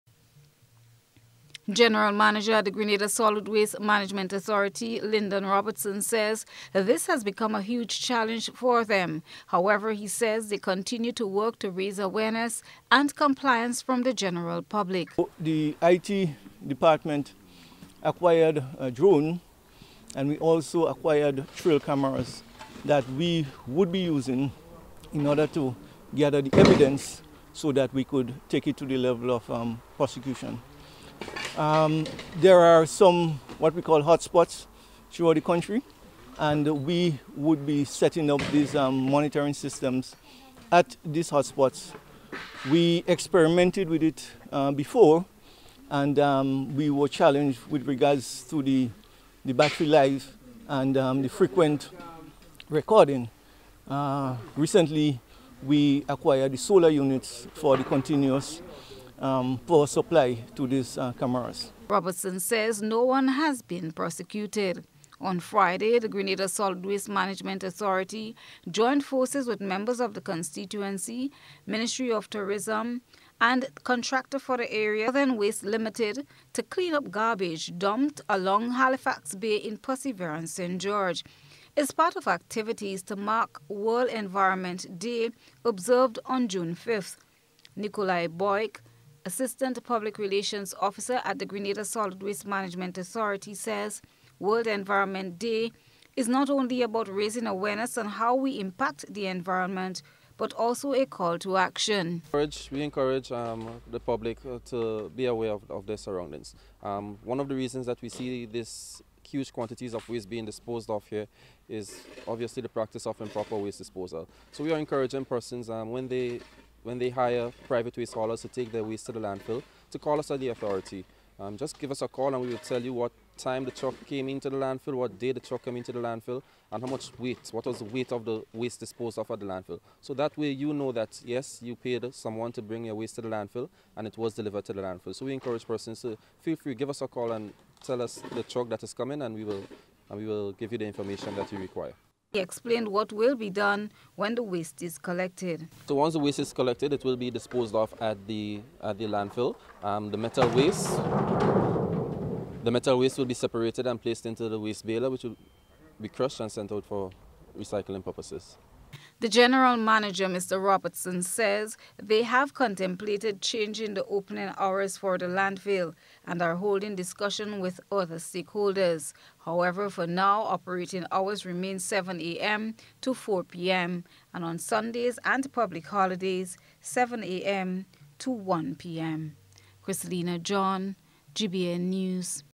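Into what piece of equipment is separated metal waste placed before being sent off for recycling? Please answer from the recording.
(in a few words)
waste baler.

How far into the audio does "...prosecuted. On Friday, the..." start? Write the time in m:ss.
1:03.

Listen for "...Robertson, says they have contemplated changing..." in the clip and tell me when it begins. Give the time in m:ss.
2:40.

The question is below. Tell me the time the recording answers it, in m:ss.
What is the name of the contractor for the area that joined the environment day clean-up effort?
1:15.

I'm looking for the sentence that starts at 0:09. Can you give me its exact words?
However, he says they continue to work to raise awareness and compliance from the general public.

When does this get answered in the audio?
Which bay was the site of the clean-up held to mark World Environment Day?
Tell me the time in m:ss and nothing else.
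1:18.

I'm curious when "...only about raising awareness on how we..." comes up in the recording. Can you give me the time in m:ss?
1:36.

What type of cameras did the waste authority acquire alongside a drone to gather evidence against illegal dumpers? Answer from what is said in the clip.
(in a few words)
trail cameras.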